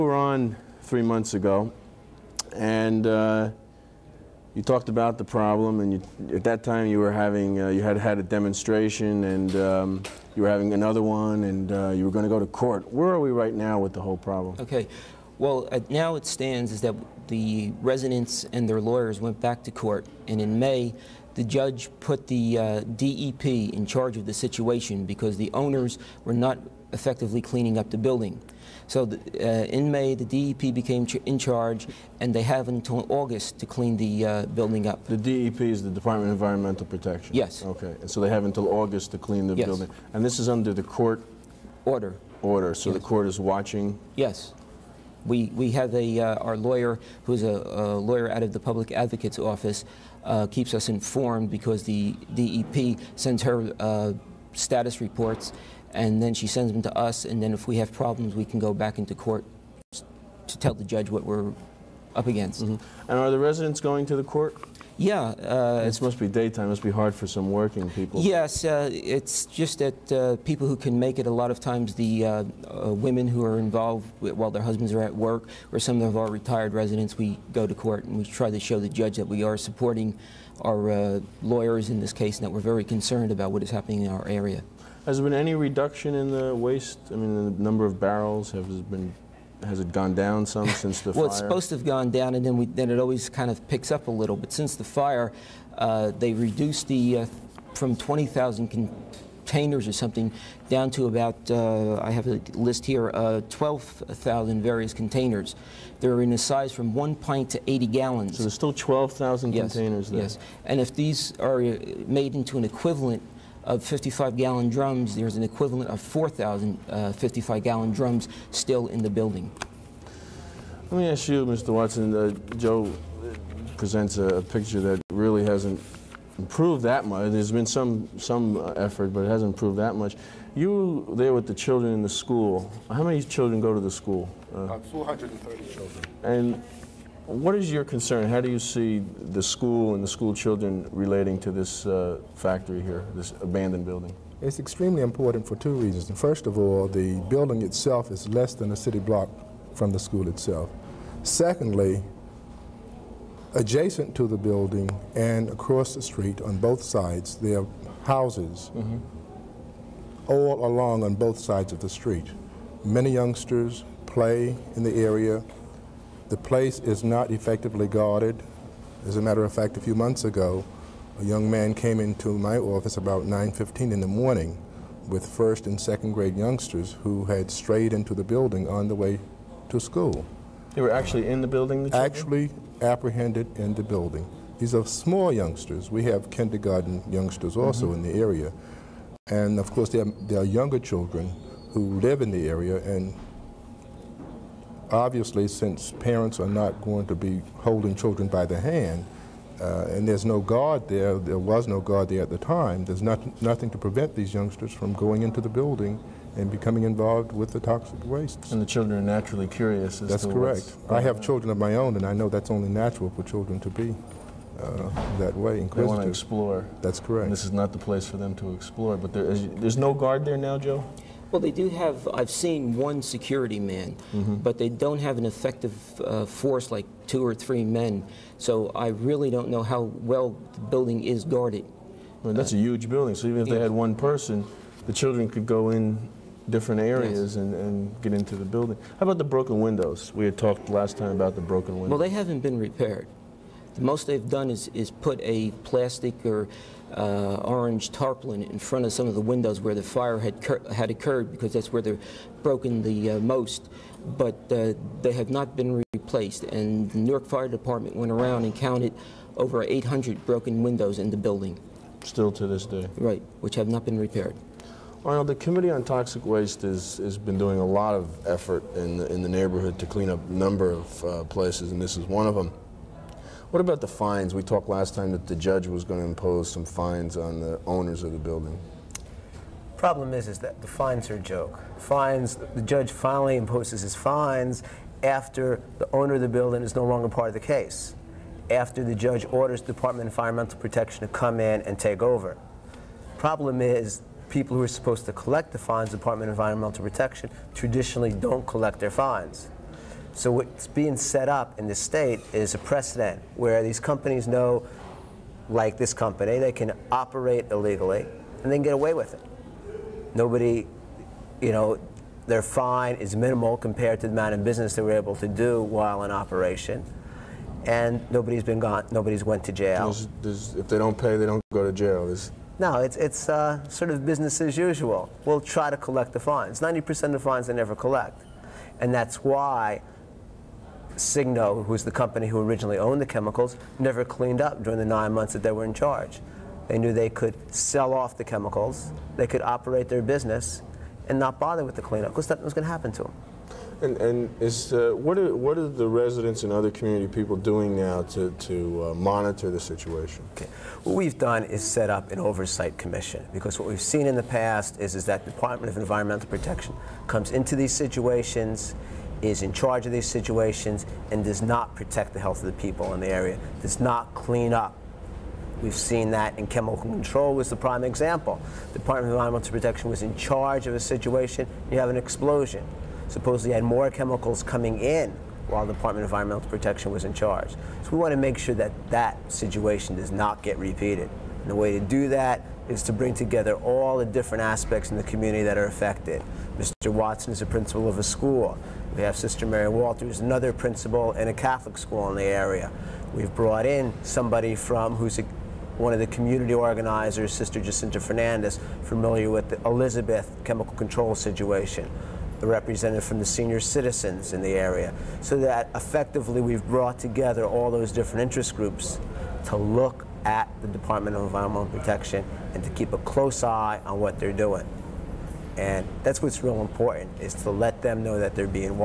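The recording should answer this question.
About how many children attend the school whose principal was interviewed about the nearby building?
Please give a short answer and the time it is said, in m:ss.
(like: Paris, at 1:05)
230, at 2:14.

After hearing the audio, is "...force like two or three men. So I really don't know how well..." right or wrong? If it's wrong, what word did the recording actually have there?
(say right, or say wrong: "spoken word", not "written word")
right.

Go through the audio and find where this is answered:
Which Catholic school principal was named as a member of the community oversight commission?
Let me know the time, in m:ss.
6:29.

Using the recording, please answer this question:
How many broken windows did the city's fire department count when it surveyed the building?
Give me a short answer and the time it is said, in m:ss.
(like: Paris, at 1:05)
Over 800, at 4:19.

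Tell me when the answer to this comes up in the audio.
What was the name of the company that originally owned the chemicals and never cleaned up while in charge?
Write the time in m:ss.
5:31.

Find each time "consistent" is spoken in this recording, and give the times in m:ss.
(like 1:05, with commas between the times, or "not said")
not said.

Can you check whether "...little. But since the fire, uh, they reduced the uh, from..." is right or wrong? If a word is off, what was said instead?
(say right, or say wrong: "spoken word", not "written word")
right.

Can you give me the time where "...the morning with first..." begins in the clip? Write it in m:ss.
2:53.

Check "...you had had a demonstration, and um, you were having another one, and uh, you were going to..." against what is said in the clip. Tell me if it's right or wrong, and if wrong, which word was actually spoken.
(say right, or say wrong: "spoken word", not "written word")
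right.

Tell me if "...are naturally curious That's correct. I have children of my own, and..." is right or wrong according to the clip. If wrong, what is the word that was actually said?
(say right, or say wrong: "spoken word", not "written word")
right.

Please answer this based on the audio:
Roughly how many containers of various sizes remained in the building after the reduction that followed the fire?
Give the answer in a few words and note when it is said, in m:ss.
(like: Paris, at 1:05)
12,000, at 1:43.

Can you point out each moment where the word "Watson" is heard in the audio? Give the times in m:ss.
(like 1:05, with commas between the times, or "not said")
2:01, 6:26.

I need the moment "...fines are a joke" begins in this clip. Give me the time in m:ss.
4:40.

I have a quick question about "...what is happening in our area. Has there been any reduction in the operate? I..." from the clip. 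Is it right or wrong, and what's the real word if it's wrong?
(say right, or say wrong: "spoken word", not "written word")
wrong: "waste", not "operate".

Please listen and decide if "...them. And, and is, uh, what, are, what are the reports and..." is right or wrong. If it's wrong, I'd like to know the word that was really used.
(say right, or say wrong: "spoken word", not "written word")
wrong: "residents", not "reports".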